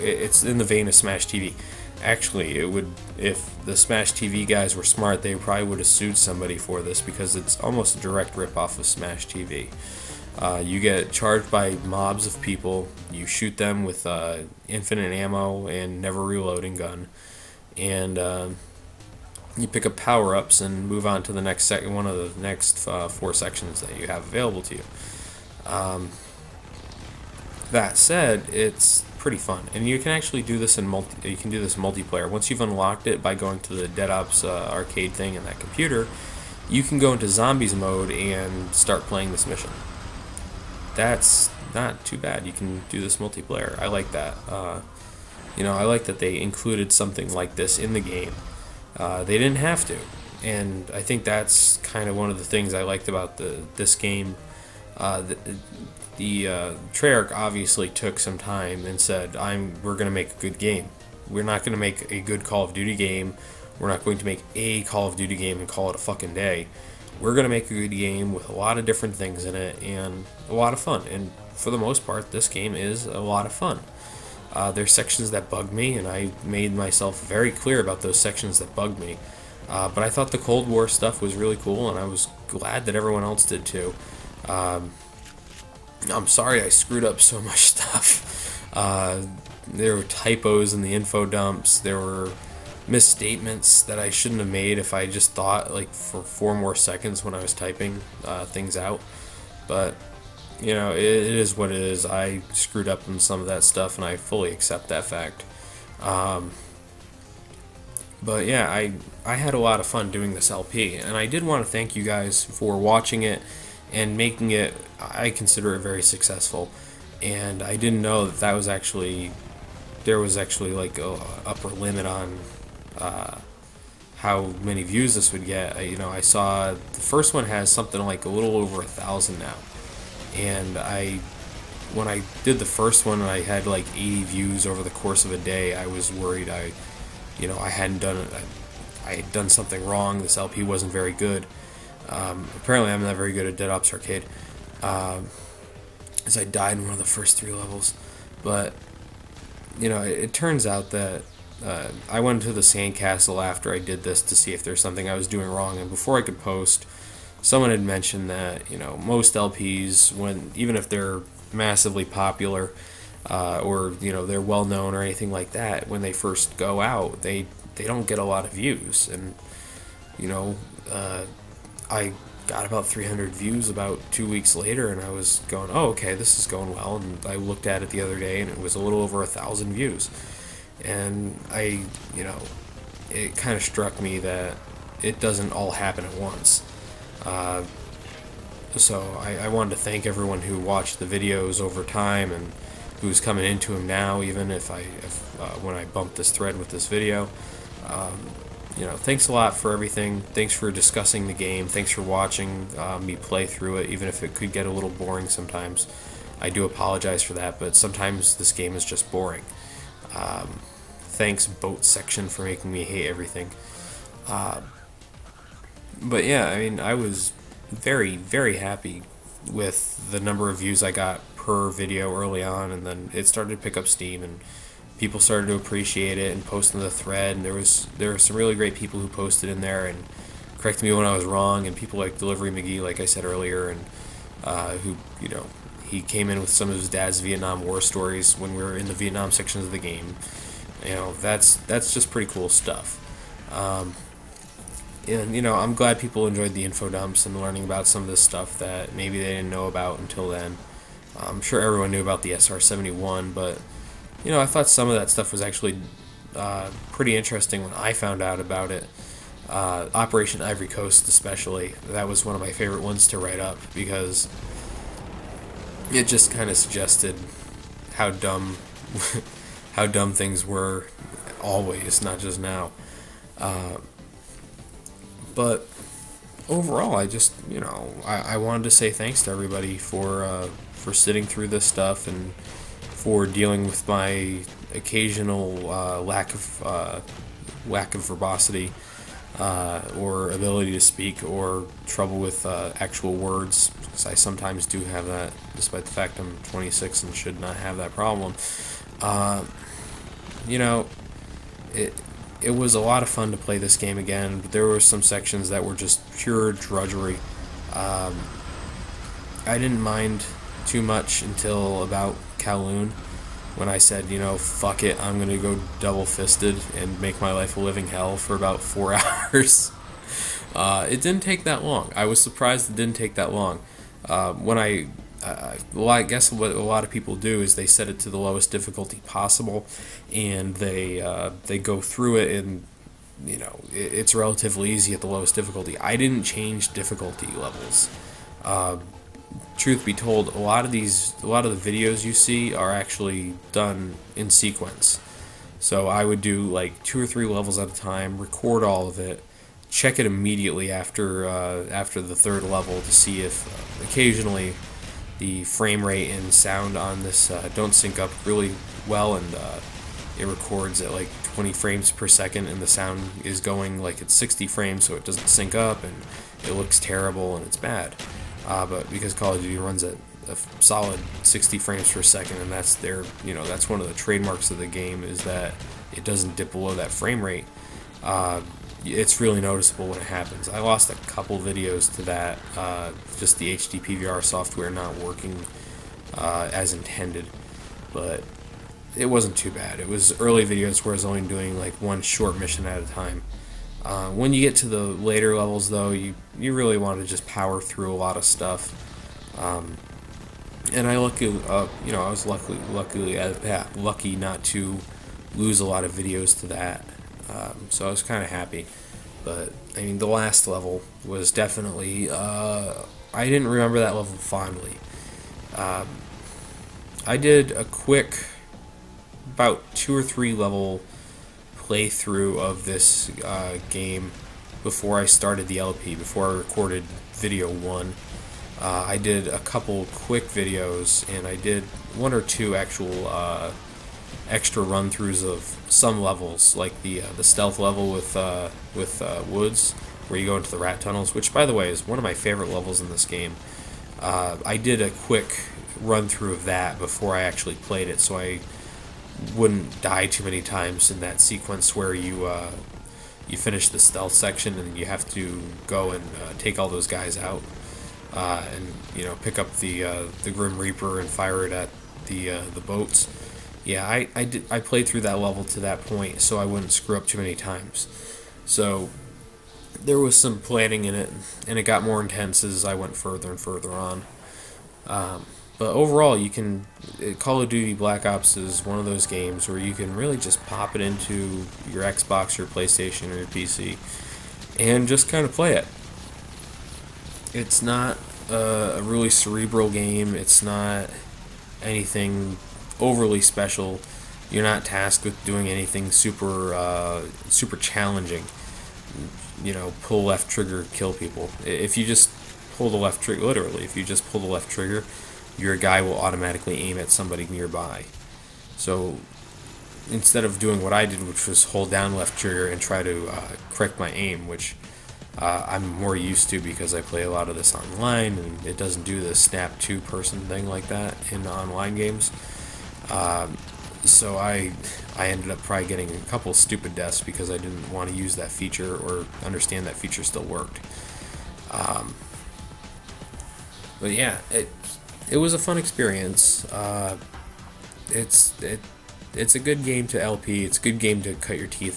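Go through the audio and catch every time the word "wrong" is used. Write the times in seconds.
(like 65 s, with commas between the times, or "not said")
139 s, 155 s, 231 s.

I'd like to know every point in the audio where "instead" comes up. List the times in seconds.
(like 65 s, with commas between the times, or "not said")
509 s.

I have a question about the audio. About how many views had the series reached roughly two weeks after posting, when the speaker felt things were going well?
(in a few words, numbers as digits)
300.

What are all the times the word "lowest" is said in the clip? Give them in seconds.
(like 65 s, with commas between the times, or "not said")
328 s, 335 s.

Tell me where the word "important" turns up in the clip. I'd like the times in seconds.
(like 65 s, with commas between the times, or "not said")
not said.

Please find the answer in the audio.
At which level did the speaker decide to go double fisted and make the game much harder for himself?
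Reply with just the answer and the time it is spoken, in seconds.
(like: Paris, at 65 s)
Kowloon, at 312 s.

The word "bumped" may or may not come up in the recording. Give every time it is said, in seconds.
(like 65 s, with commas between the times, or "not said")
195 s.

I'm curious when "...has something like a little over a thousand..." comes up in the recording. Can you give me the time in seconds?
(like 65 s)
127 s.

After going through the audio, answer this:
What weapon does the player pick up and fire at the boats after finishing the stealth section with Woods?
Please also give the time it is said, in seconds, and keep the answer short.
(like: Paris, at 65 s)
Grim Reaper, at 460 s.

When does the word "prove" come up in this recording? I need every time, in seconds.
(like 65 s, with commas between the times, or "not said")
not said.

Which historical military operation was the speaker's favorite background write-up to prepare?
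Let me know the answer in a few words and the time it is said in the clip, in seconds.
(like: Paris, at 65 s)
Operation Ivory Coast, at 259 s.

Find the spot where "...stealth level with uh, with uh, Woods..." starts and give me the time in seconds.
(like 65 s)
437 s.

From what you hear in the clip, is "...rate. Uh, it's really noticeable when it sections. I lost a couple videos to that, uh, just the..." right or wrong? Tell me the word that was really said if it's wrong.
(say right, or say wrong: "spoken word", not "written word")
wrong: "happens", not "sections".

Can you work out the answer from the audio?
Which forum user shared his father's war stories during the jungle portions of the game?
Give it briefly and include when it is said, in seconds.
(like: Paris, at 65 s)
Delivery McGee, at 232 s.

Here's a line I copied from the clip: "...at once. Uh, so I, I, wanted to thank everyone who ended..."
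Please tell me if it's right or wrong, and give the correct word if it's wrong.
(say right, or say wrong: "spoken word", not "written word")
wrong: "watched", not "ended".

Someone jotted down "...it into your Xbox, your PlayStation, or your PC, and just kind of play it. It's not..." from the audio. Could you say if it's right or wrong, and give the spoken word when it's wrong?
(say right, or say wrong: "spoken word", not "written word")
right.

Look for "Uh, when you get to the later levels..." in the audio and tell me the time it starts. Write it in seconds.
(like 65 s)
393 s.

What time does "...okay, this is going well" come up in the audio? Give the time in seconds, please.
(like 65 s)
175 s.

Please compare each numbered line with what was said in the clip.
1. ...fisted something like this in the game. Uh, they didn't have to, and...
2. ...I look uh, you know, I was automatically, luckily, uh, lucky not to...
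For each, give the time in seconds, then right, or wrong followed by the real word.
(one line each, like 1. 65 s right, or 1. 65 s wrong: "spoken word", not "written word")
1. 46 s wrong: "included", not "fisted"
2. 400 s wrong: "luckily", not "automatically".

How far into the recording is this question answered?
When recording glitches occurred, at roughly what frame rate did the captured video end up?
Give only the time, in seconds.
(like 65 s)
361 s.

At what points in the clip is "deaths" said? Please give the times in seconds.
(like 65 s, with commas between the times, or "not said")
526 s.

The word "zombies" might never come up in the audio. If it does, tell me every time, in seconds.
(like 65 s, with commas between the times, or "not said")
37 s.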